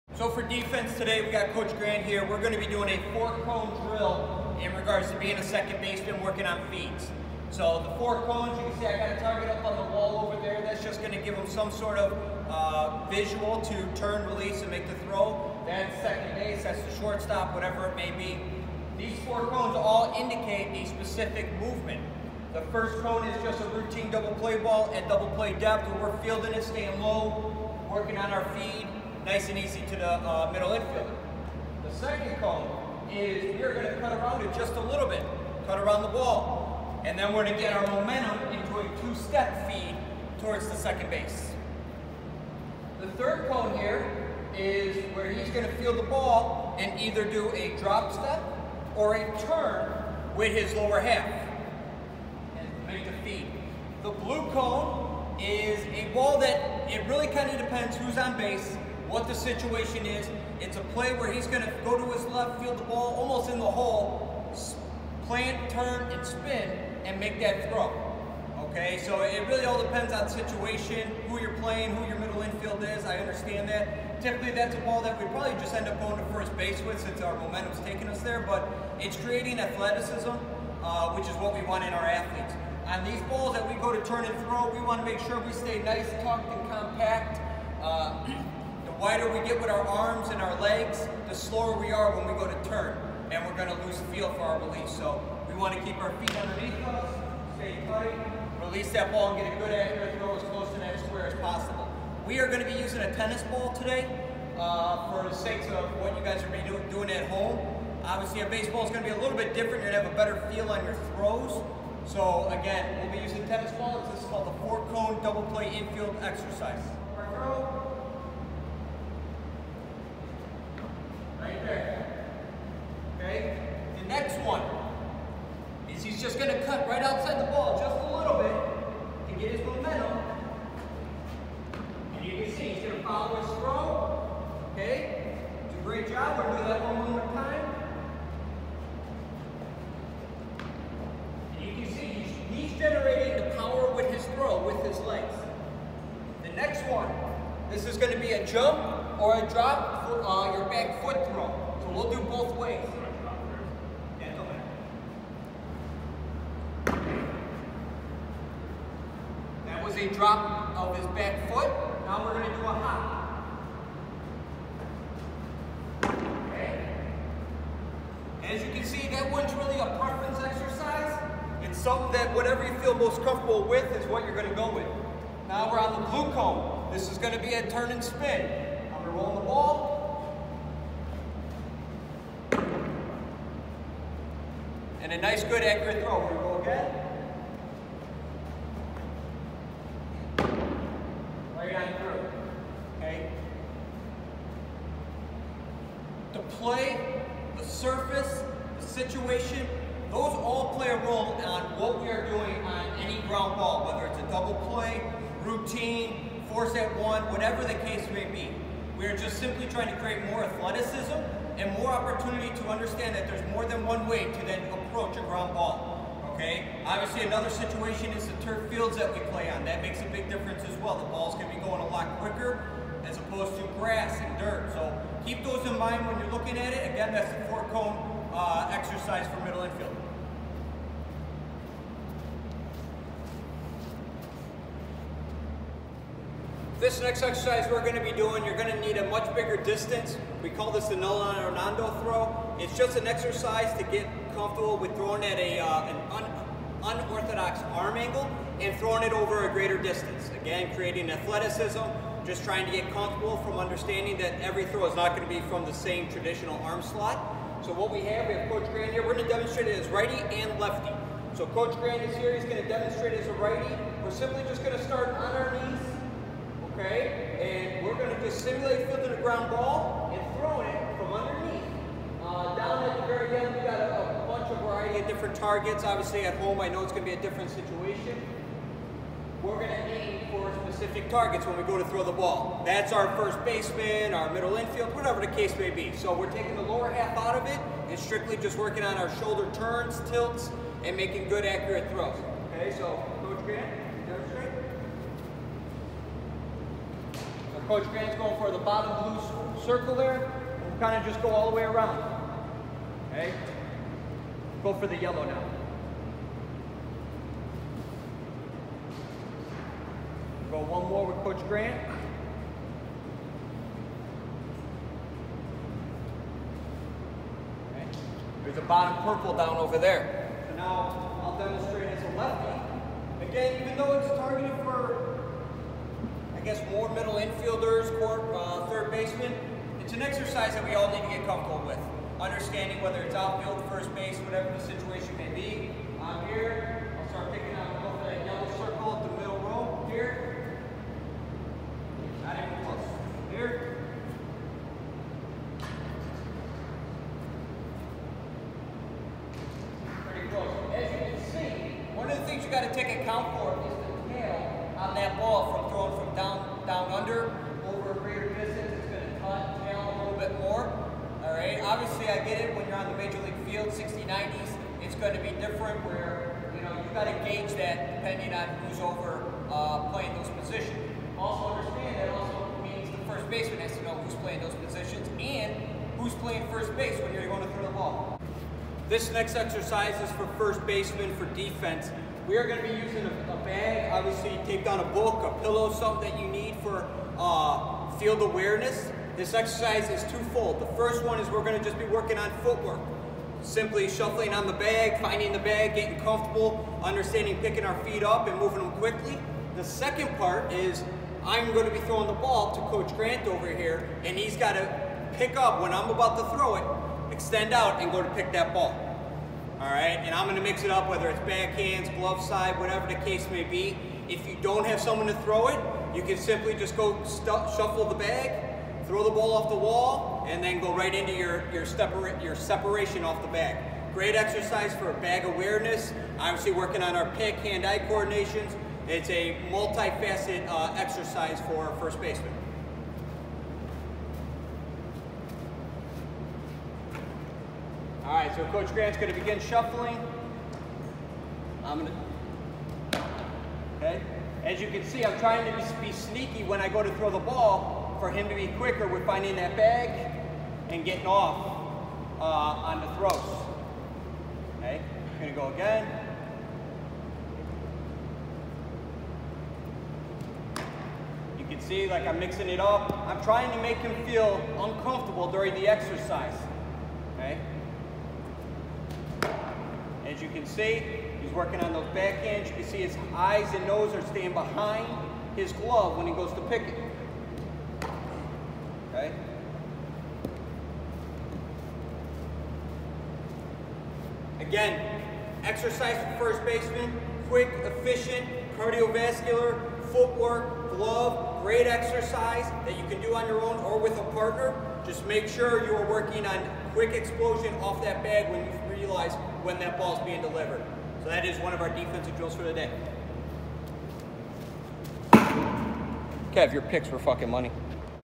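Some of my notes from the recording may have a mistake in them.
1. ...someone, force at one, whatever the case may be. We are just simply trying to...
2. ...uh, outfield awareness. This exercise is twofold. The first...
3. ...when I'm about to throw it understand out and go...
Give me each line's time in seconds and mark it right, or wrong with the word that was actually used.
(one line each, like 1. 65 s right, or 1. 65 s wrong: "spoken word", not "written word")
1. 205 s wrong: "routine", not "someone"
2. 387 s wrong: "field", not "outfield"
3. 405 s wrong: "extend", not "understand".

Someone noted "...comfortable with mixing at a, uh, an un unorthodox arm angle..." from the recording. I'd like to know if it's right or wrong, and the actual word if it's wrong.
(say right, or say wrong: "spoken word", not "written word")
wrong: "throwing", not "mixing".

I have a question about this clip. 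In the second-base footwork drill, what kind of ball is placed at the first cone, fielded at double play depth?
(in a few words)
Routine double play ball.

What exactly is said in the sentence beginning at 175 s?
Now we're on the blue cone.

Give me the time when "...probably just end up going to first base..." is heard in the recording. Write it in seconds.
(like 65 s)
75 s.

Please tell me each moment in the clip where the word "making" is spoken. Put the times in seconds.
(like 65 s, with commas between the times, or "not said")
290 s.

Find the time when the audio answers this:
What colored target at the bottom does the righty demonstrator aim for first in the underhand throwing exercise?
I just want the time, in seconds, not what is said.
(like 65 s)
298 s.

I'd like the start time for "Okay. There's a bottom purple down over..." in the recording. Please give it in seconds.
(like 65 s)
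317 s.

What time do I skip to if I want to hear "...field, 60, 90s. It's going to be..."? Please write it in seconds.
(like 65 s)
363 s.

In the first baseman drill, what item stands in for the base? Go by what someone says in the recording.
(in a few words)
A bag.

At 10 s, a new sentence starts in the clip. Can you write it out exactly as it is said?
That's just going to give them some sort of uh, visual to turn, release, and make the throw.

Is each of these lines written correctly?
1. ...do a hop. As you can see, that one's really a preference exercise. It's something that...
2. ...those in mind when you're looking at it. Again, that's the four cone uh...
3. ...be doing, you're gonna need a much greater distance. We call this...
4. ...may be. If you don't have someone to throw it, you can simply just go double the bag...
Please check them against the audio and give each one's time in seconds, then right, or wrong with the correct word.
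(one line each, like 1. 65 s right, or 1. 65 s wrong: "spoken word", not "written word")
1. 162 s right
2. 225 s right
3. 238 s wrong: "bigger", not "greater"
4. 413 s wrong: "shuffle", not "double".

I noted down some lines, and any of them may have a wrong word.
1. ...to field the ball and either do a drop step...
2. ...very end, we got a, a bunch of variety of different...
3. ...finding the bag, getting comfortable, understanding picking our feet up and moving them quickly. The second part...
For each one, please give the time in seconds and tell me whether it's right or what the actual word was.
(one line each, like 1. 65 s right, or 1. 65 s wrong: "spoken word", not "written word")
1. 45 s right
2. 273 s right
3. 395 s right.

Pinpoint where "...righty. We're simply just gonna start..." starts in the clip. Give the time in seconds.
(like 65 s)
263 s.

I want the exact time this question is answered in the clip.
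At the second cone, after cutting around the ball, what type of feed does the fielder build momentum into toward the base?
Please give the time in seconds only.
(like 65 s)
39 s.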